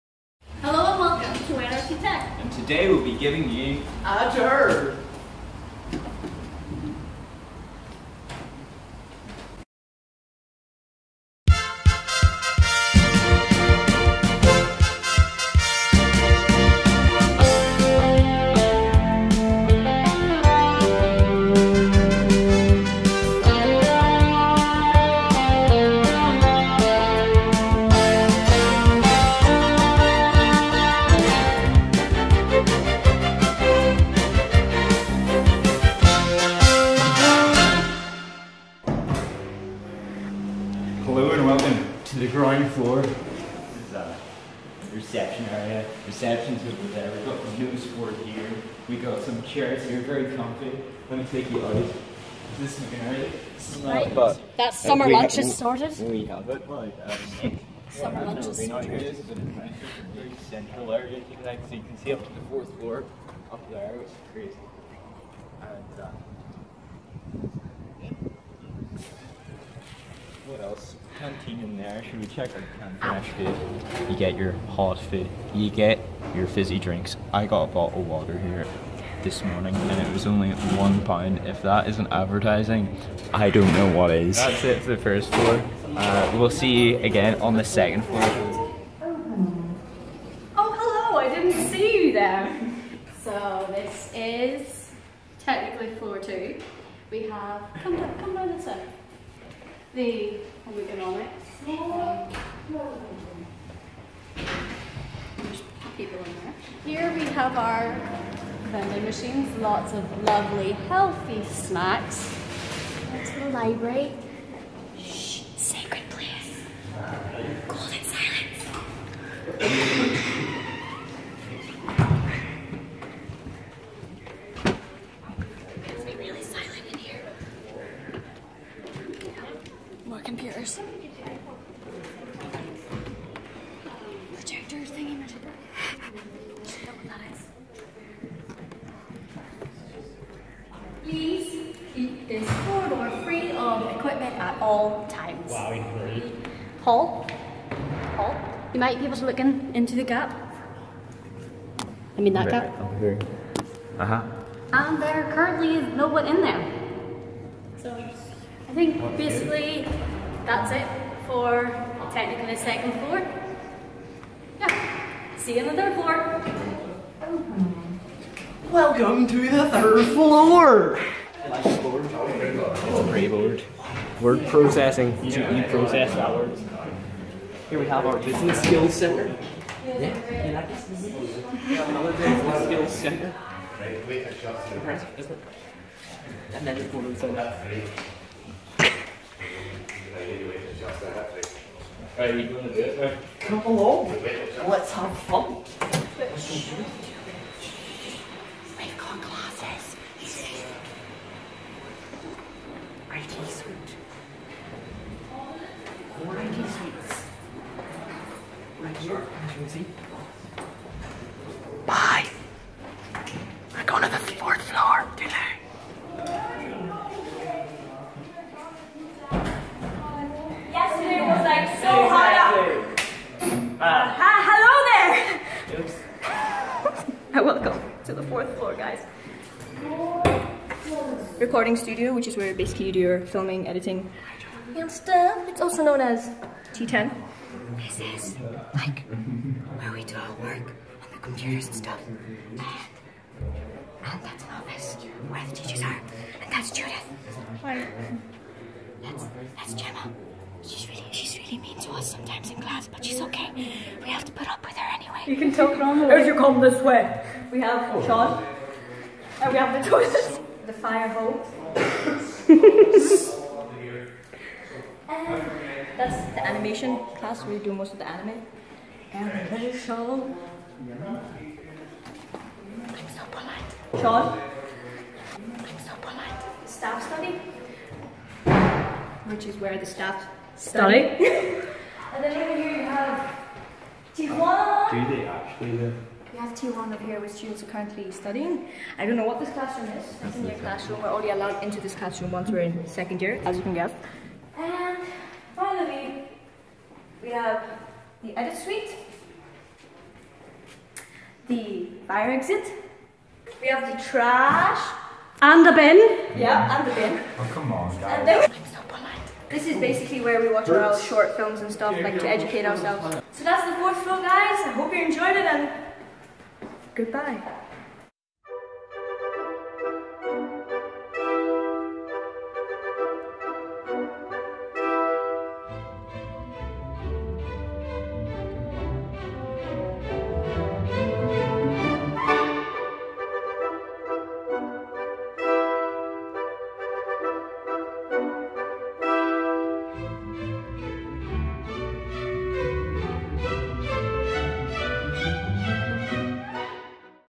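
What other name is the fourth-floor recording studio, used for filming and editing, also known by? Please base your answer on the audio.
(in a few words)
T10.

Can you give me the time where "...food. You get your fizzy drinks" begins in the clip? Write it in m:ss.
1:14.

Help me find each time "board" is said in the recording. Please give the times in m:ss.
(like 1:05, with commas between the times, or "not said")
0:47, 2:53.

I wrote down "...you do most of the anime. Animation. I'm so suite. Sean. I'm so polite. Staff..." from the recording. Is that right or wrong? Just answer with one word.
wrong.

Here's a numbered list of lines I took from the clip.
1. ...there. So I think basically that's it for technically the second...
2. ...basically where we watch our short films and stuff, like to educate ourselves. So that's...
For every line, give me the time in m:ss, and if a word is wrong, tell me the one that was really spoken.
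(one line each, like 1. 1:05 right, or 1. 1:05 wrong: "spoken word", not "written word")
1. 2:36 right
2. 5:09 right.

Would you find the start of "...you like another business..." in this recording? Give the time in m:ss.
2:59.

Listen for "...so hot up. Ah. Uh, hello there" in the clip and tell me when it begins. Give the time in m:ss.
3:41.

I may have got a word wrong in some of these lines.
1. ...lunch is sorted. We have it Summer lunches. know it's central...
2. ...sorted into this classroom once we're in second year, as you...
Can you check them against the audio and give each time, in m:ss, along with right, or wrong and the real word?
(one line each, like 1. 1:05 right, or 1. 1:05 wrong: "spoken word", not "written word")
1. 0:55 right
2. 4:51 wrong: "allowed", not "sorted".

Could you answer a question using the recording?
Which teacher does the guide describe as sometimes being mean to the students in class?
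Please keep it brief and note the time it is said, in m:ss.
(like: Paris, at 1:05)
Gemma, at 4:09.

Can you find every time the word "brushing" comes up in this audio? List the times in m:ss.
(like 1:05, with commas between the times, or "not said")
not said.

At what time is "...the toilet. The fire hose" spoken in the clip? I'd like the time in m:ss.
4:19.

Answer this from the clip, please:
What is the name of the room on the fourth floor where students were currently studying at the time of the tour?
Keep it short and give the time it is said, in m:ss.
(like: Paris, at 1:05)
T1, at 4:46.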